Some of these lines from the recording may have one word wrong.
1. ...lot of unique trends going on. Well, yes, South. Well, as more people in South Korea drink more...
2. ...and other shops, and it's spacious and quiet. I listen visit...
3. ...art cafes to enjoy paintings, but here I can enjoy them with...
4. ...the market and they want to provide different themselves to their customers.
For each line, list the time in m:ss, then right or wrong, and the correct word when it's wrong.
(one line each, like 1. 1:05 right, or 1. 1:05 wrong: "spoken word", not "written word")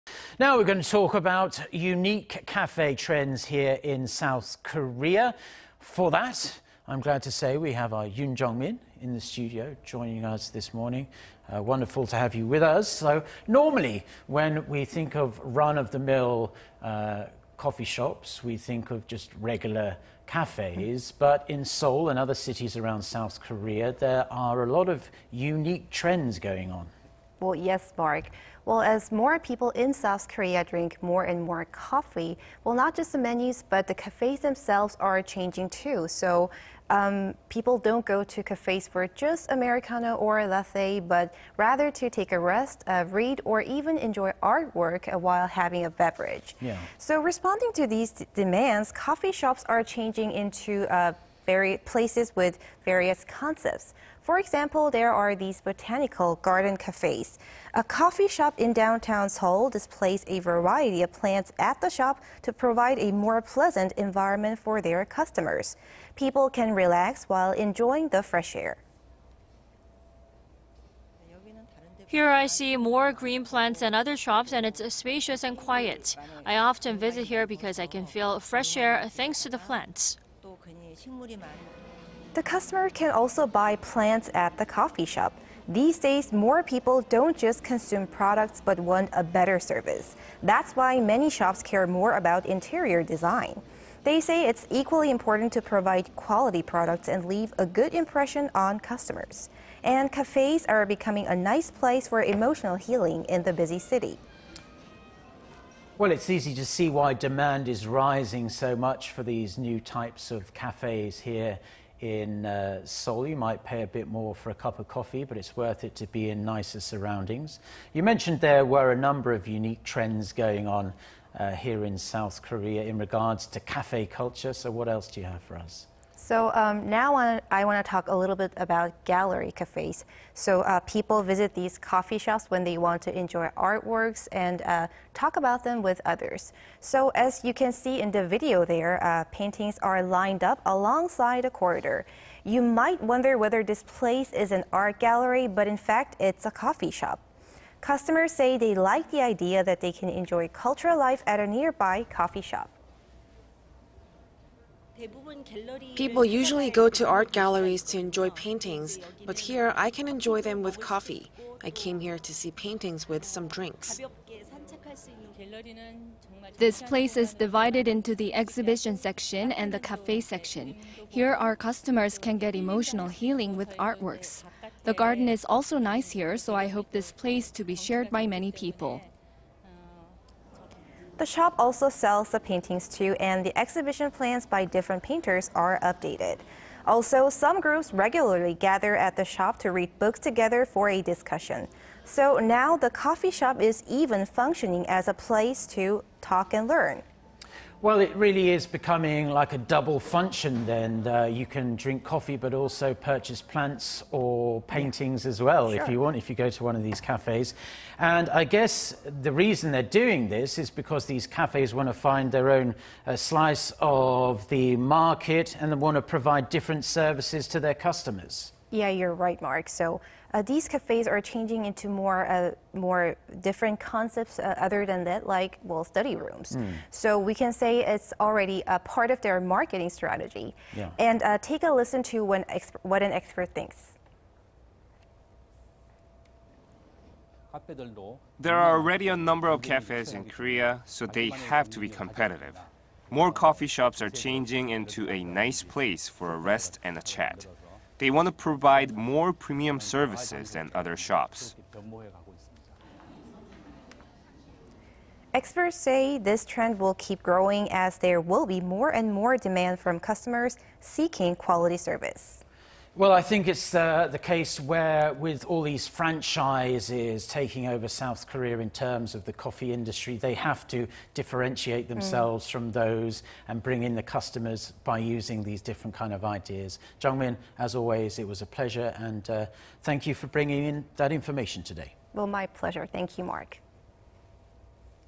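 1. 0:24 wrong: "Mark", not "South"
2. 1:13 wrong: "often", not "listen"
3. 2:37 wrong: "galleries", not "cafes"
4. 3:34 wrong: "services", not "themselves".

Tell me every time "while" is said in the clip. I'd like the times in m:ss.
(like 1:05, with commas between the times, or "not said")
0:45, 1:07.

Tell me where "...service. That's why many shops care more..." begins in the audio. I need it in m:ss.
1:29.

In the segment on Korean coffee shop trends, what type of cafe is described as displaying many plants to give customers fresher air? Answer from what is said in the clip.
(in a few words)
Botanical garden cafes.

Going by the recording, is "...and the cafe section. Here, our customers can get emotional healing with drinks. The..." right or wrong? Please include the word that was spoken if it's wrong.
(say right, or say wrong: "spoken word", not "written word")
wrong: "artworks", not "drinks".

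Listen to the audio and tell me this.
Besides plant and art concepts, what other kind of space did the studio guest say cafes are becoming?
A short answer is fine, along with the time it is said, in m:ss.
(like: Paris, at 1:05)
Study rooms, at 3:45.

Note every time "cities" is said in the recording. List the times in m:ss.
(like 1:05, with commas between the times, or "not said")
0:22.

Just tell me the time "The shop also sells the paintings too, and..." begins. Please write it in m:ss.
3:01.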